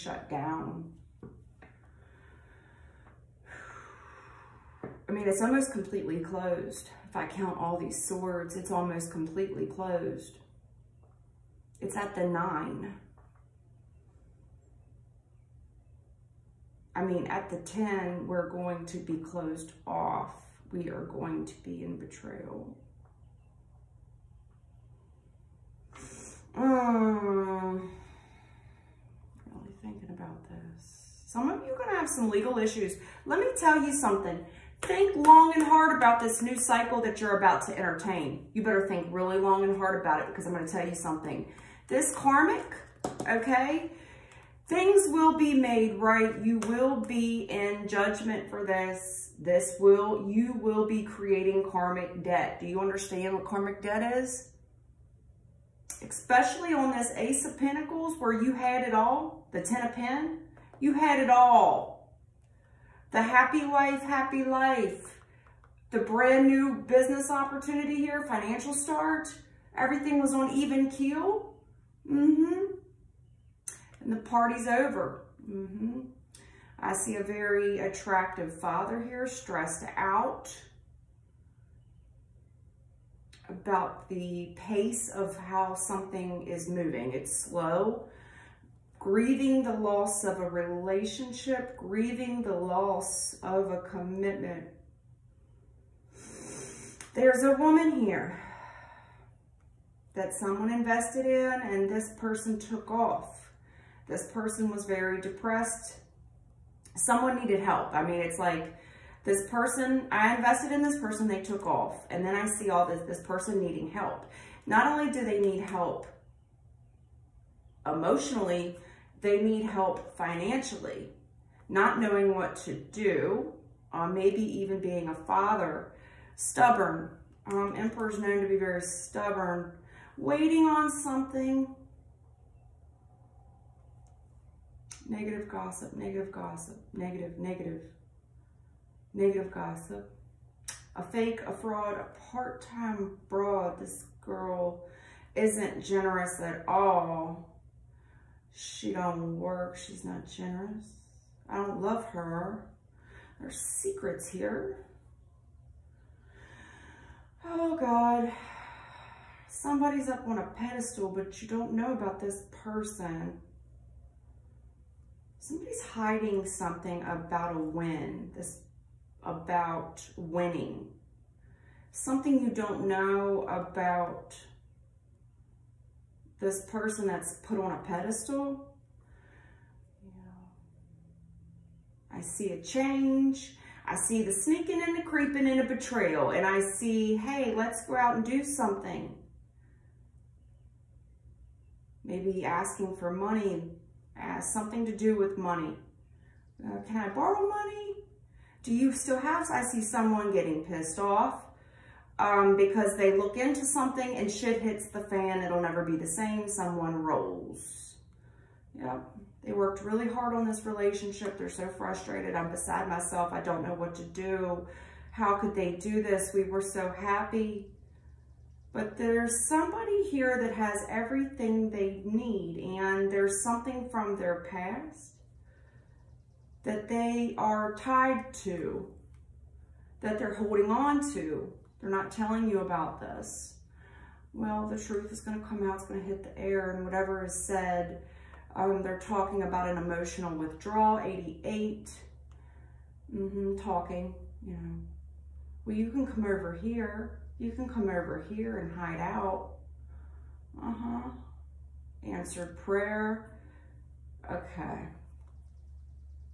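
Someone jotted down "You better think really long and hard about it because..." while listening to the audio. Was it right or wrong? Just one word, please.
right.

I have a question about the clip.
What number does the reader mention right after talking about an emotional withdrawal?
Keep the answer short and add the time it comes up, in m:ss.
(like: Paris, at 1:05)
88, at 4:00.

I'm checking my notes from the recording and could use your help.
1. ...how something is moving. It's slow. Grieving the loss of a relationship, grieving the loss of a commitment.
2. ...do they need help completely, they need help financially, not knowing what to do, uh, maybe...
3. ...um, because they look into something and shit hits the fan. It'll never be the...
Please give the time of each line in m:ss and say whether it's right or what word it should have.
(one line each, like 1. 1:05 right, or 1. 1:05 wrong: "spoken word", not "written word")
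1. 1:25 right
2. 1:55 wrong: "emotionally", not "completely"
3. 3:22 right.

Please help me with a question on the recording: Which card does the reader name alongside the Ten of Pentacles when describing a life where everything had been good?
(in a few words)
Ace of Pentacles.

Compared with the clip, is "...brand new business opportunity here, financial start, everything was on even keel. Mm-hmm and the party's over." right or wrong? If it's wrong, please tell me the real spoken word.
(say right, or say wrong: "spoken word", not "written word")
right.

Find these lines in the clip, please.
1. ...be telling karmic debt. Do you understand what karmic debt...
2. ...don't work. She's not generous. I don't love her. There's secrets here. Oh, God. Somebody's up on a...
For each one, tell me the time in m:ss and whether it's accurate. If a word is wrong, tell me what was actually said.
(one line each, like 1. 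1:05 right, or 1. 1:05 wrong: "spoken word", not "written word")
1. 0:50 wrong: "creating", not "telling"
2. 2:28 right.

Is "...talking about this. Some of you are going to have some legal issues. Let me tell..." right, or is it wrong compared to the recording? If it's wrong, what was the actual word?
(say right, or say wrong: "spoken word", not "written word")
wrong: "thinking", not "talking".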